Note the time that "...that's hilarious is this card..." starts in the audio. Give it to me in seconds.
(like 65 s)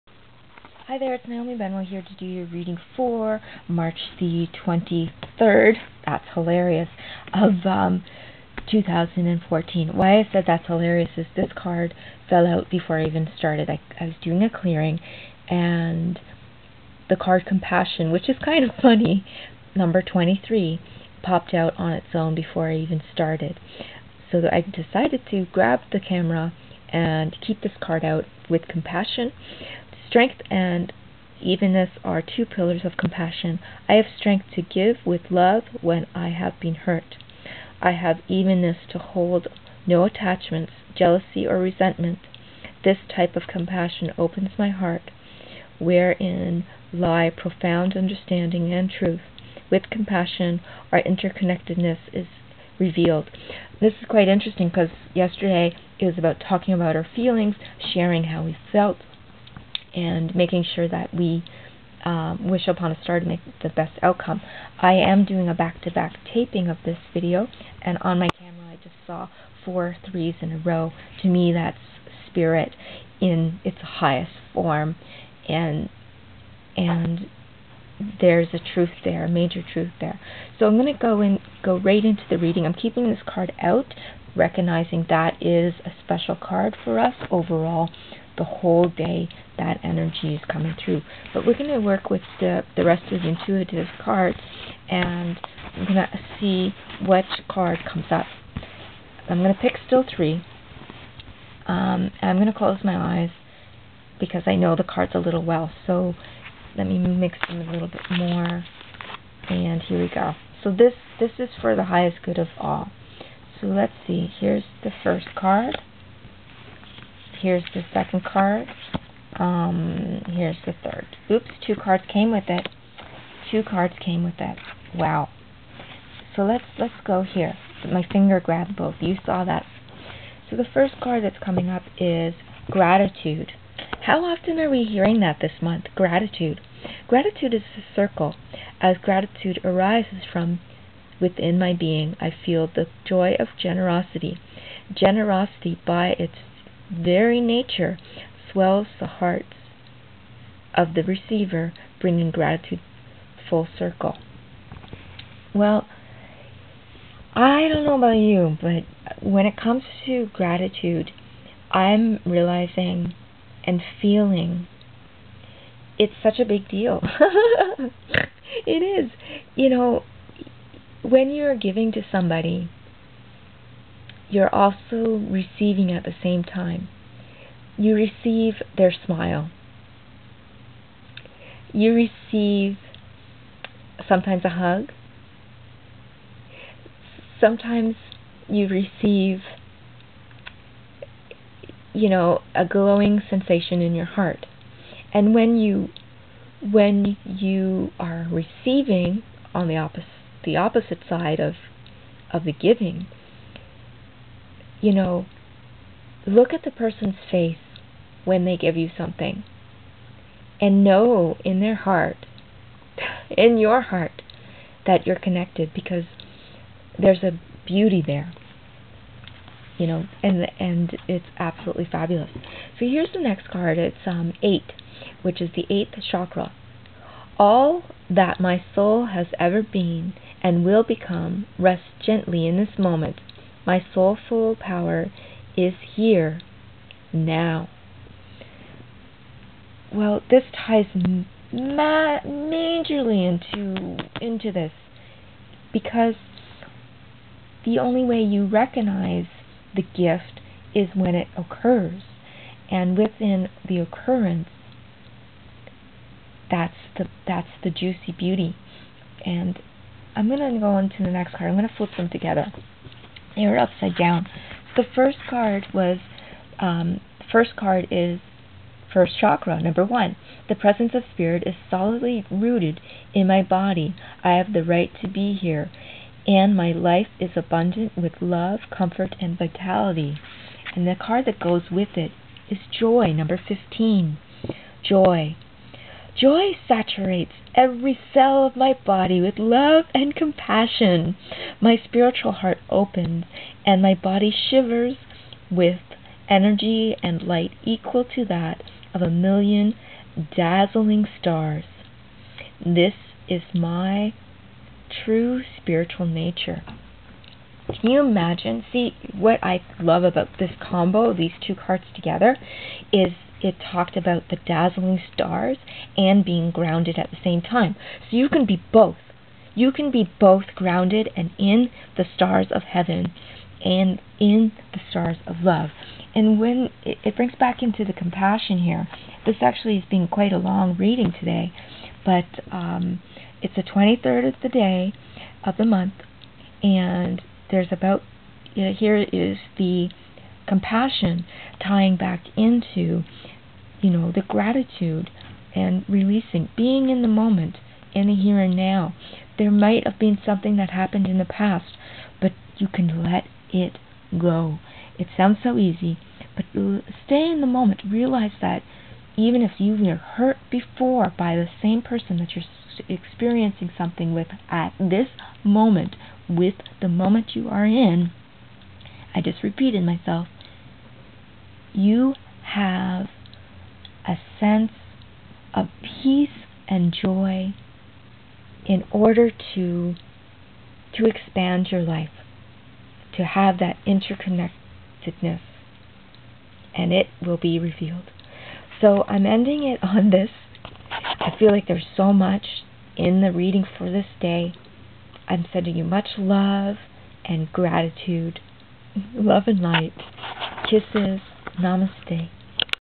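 10 s.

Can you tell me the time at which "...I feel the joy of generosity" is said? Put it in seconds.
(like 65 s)
142 s.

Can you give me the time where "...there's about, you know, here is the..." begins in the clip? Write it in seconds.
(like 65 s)
337 s.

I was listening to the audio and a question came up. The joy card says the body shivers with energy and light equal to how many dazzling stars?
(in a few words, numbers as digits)
a million.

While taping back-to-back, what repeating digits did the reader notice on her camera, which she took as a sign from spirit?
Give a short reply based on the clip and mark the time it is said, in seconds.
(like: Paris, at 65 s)
four threes, at 69 s.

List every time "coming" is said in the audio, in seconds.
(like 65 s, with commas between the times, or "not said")
90 s, 131 s.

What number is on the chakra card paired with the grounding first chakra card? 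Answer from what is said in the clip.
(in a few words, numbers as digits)
15.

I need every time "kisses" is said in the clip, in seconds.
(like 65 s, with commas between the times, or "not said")
400 s.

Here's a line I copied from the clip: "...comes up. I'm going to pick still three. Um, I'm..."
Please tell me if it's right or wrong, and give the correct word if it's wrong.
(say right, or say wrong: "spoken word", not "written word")
right.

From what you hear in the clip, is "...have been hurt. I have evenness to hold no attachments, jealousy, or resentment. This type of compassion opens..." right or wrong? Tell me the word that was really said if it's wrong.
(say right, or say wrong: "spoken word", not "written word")
right.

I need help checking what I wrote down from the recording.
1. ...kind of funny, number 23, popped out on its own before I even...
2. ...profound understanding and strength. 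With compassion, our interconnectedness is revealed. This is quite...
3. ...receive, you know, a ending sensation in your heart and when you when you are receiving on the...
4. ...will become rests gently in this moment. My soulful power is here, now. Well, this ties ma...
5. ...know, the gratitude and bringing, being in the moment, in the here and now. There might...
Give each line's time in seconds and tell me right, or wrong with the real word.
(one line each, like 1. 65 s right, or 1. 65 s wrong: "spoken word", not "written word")
1. 18 s right
2. 47 s wrong: "truth", not "strength"
3. 188 s wrong: "glowing", not "ending"
4. 230 s right
5. 343 s wrong: "releasing", not "bringing".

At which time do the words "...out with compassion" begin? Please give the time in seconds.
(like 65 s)
28 s.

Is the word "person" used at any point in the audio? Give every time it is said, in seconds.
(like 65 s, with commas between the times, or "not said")
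206 s, 361 s.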